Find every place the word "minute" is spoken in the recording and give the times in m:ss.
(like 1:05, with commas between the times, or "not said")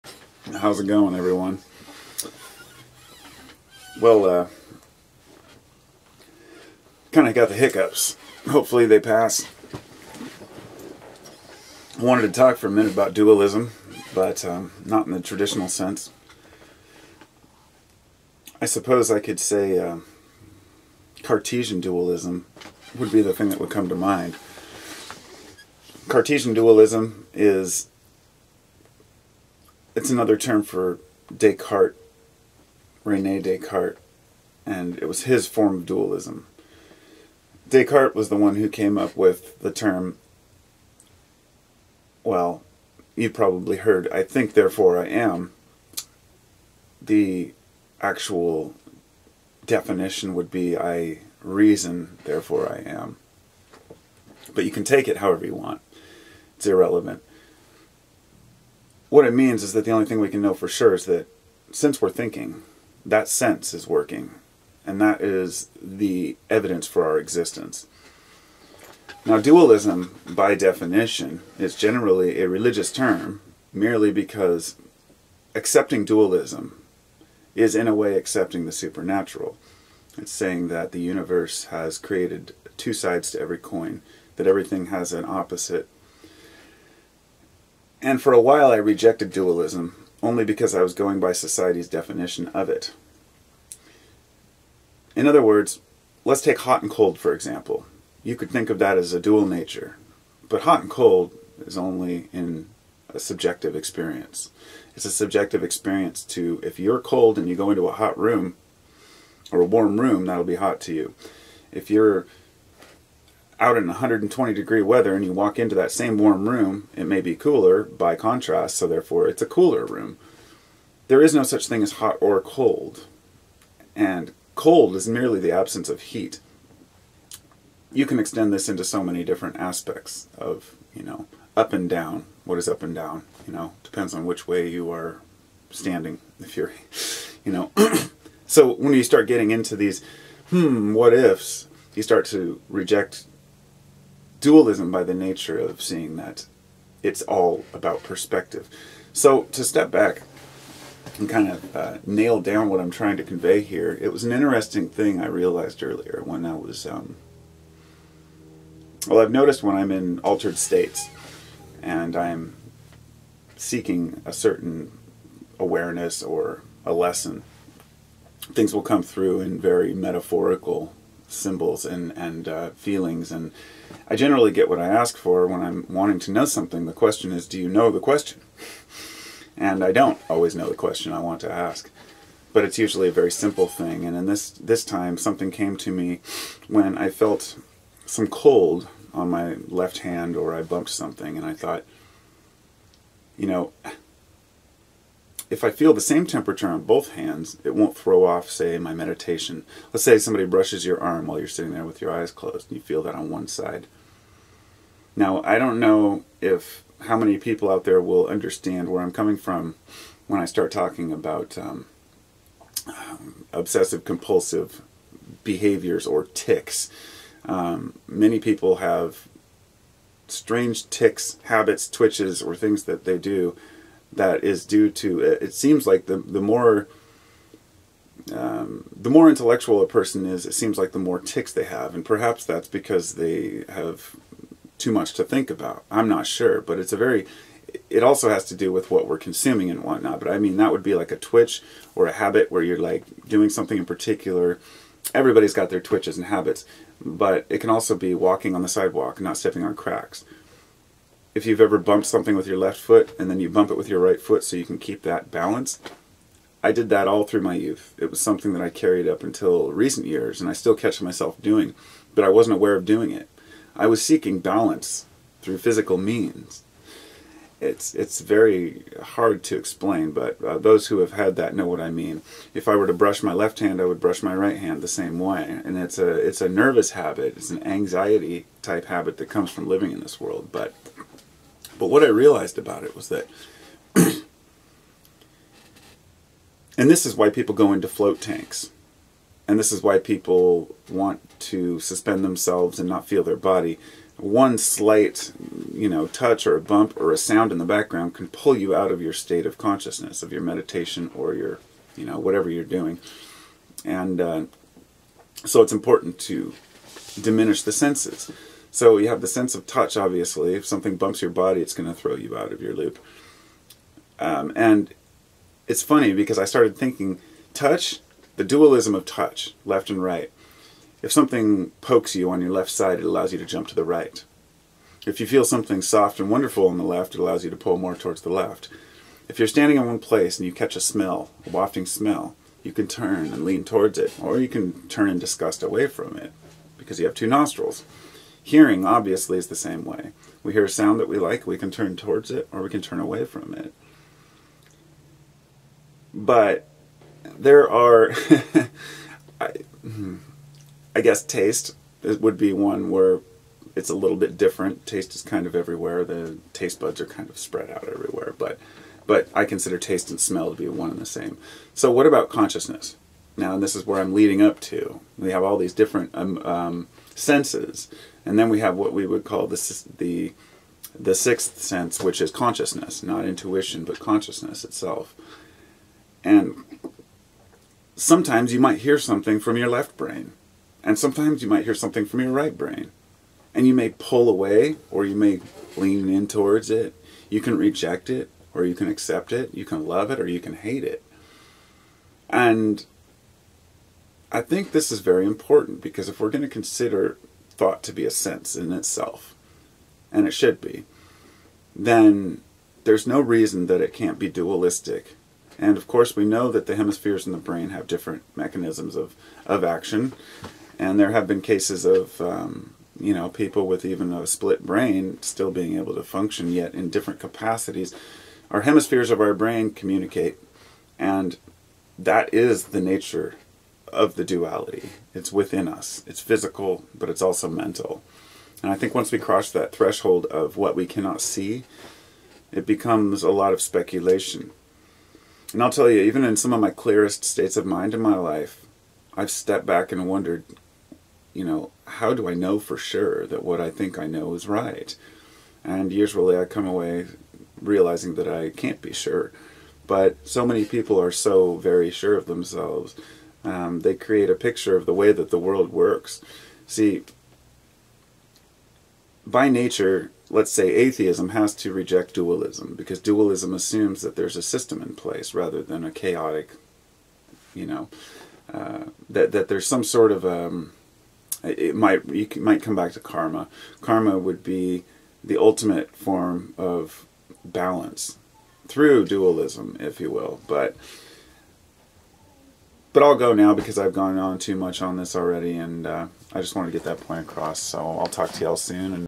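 0:12.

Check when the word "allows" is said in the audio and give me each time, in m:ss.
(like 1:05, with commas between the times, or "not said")
5:23, 5:27.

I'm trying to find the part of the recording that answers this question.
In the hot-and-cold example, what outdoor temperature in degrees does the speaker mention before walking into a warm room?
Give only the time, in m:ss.
1:53.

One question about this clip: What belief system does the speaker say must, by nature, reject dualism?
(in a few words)
atheism.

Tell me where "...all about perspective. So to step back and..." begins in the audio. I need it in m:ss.
2:27.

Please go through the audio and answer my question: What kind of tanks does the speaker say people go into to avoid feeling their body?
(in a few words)
float tanks.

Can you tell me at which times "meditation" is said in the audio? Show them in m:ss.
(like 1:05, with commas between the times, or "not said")
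3:18, 5:00.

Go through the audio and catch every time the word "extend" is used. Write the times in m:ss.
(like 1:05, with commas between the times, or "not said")
2:08.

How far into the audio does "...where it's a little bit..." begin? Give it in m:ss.
5:52.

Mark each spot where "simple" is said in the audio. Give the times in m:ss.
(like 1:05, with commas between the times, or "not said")
3:03.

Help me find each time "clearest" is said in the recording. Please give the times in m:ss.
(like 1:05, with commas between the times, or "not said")
7:16.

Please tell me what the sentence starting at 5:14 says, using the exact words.
Um, and it's funny because I started thinking touch, the dualism of touch, left and right.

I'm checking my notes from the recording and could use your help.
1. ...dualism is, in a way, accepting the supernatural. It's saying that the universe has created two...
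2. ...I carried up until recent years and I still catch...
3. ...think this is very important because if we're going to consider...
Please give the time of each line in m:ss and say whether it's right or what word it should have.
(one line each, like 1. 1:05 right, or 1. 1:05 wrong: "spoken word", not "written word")
1. 1:16 right
2. 4:18 right
3. 6:34 right.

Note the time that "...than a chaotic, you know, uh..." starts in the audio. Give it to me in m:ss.
7:45.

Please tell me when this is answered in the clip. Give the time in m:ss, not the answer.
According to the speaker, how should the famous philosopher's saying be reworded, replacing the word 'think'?
0:50.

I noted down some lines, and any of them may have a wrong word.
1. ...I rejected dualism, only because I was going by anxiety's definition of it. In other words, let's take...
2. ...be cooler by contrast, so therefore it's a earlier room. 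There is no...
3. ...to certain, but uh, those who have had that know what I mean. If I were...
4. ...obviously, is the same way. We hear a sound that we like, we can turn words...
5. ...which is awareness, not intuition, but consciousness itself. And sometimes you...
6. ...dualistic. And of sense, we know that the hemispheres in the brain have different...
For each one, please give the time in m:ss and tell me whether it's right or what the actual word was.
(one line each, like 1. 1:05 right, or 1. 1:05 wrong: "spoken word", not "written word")
1. 1:28 wrong: "society", not "anxiety"
2. 1:57 wrong: "cooler", not "earlier"
3. 4:29 wrong: "explain", not "certain"
4. 5:38 wrong: "towards", not "words"
5. 6:12 wrong: "consciousness", not "awareness"
6. 6:44 wrong: "course", not "sense".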